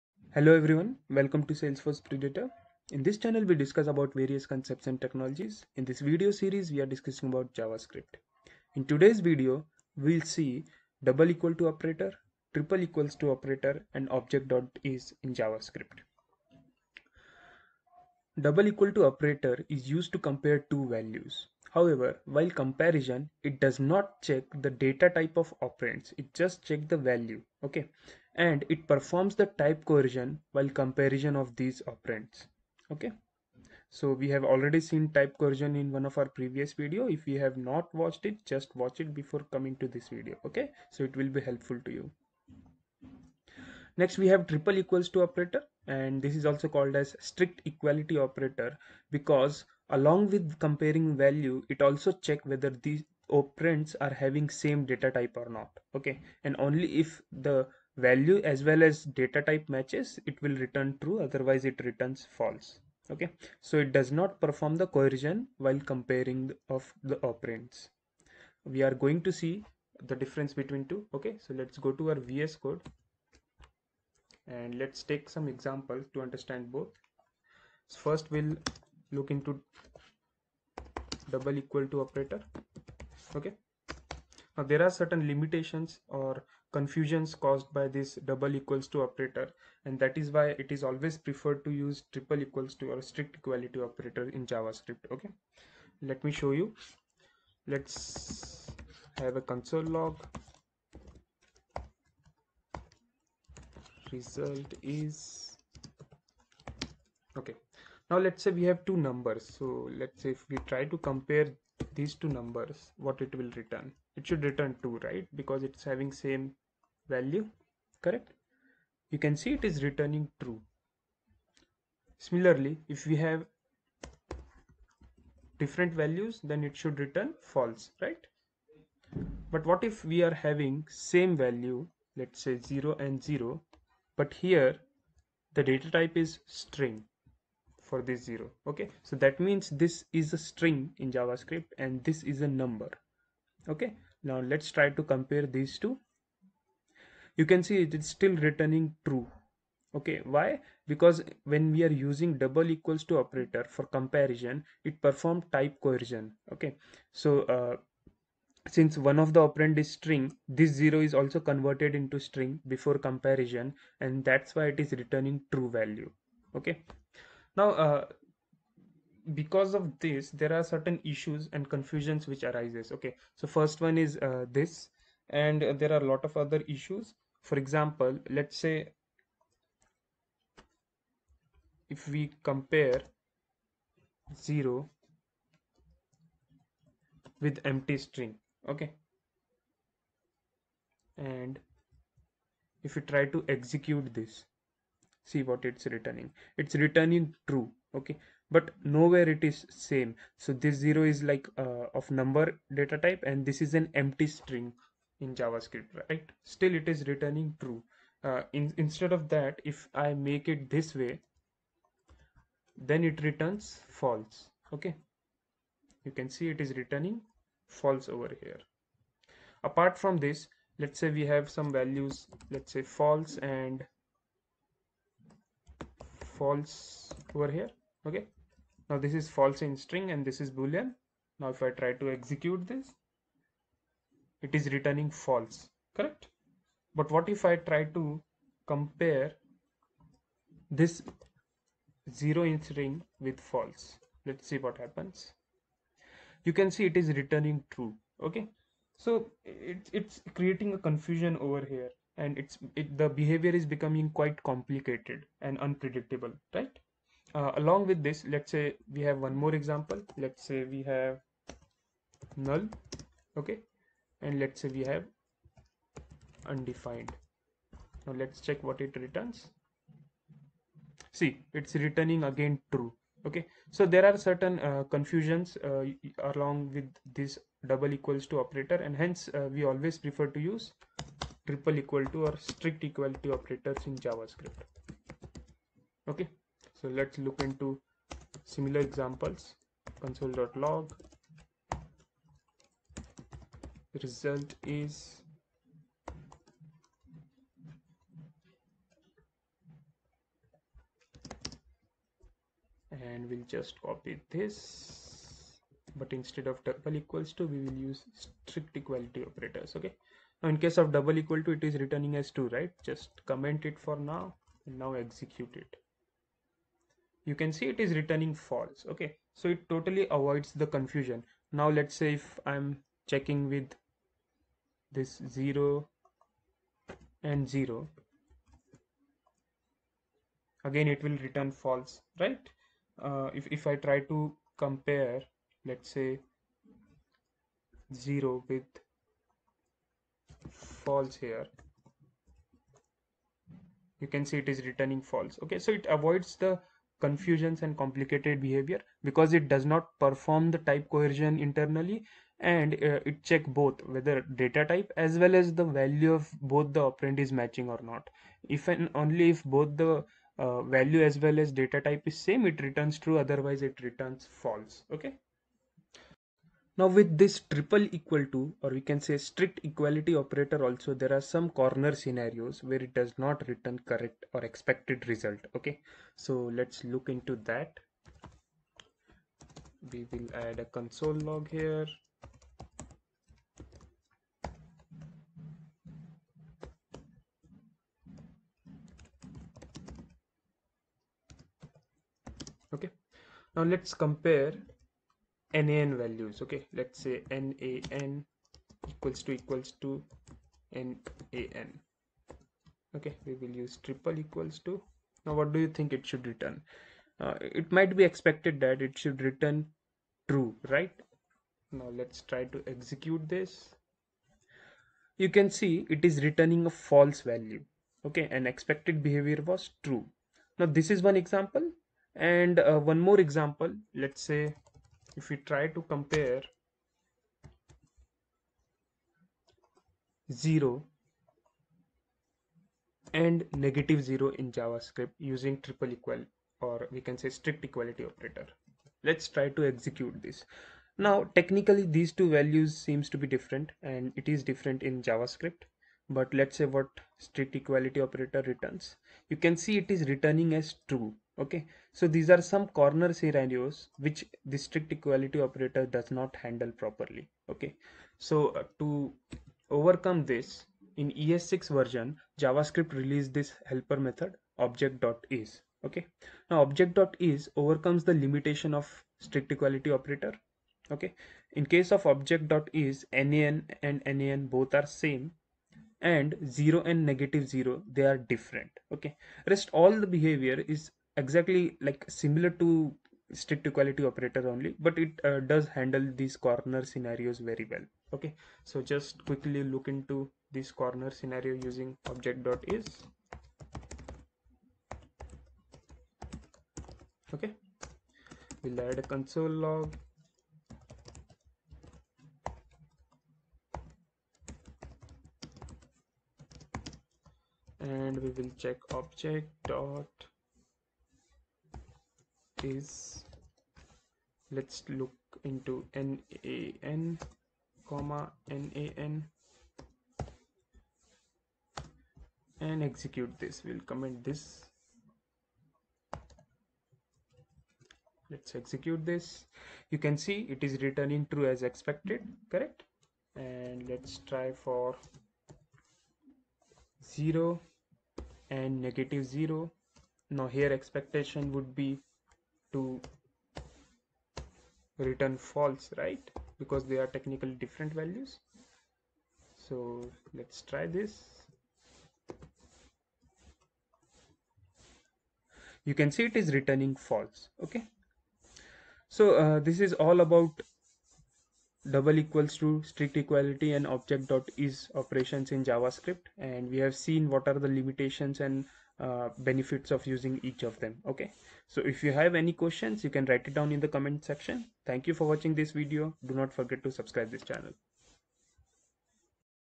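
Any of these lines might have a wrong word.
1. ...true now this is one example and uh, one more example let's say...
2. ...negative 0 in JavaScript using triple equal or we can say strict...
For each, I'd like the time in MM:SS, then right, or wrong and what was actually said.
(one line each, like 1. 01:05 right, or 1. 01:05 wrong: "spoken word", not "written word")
1. 06:59 right
2. 07:13 right.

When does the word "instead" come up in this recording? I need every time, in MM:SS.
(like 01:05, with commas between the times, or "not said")
03:28, 05:06.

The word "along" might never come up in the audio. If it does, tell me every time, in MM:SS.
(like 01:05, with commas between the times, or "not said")
00:49, 04:17, 04:36.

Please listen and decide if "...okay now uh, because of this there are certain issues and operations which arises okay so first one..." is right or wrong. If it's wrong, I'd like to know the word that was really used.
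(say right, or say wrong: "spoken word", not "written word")
wrong: "confusions", not "operations".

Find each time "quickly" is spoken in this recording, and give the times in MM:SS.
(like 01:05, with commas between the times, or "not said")
08:09.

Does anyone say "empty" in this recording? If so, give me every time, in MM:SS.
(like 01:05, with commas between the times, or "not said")
03:07, 03:23.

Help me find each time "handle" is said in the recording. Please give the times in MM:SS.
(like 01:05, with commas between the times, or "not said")
07:36, 08:05.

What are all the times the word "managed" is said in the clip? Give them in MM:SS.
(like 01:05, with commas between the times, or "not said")
not said.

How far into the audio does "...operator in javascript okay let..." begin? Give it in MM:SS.
01:33.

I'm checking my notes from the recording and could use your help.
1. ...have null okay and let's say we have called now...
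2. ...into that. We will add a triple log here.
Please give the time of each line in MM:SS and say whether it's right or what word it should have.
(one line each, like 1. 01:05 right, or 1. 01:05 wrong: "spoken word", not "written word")
1. 04:20 wrong: "undefined", not "called"
2. 06:17 wrong: "console", not "triple".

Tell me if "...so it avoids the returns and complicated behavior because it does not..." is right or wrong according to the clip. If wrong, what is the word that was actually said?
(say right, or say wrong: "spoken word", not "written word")
wrong: "confusions", not "returns".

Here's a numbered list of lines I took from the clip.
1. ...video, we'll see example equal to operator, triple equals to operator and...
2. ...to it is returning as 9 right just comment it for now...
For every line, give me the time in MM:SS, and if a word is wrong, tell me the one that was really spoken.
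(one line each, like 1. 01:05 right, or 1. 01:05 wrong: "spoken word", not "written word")
1. 00:09 wrong: "double", not "example"
2. 05:11 wrong: "2", not "9".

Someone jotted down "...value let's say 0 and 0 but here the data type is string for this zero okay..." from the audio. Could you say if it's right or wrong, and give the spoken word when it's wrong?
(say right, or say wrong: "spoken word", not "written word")
right.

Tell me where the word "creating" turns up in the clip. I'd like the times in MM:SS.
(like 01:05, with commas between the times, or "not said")
04:10.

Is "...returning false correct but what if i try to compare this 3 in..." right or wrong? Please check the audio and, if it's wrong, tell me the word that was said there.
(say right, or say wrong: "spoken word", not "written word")
wrong: "0", not "3".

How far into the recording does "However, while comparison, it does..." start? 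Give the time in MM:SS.
00:21.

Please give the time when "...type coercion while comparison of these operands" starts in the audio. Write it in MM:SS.
00:29.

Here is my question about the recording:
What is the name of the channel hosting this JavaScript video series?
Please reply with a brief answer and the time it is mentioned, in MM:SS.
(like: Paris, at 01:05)
Salesforce Predator, at 00:01.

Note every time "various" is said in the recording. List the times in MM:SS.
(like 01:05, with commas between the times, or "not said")
00:04.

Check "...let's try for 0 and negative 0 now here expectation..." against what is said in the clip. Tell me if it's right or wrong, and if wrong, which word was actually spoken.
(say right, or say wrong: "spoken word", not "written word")
right.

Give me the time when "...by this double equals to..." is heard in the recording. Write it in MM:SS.
01:27.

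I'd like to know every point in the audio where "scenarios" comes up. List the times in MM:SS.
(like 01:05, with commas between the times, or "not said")
06:11, 07:33, 08:06, 08:11.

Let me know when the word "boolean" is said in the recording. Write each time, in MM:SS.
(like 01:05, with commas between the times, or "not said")
03:50.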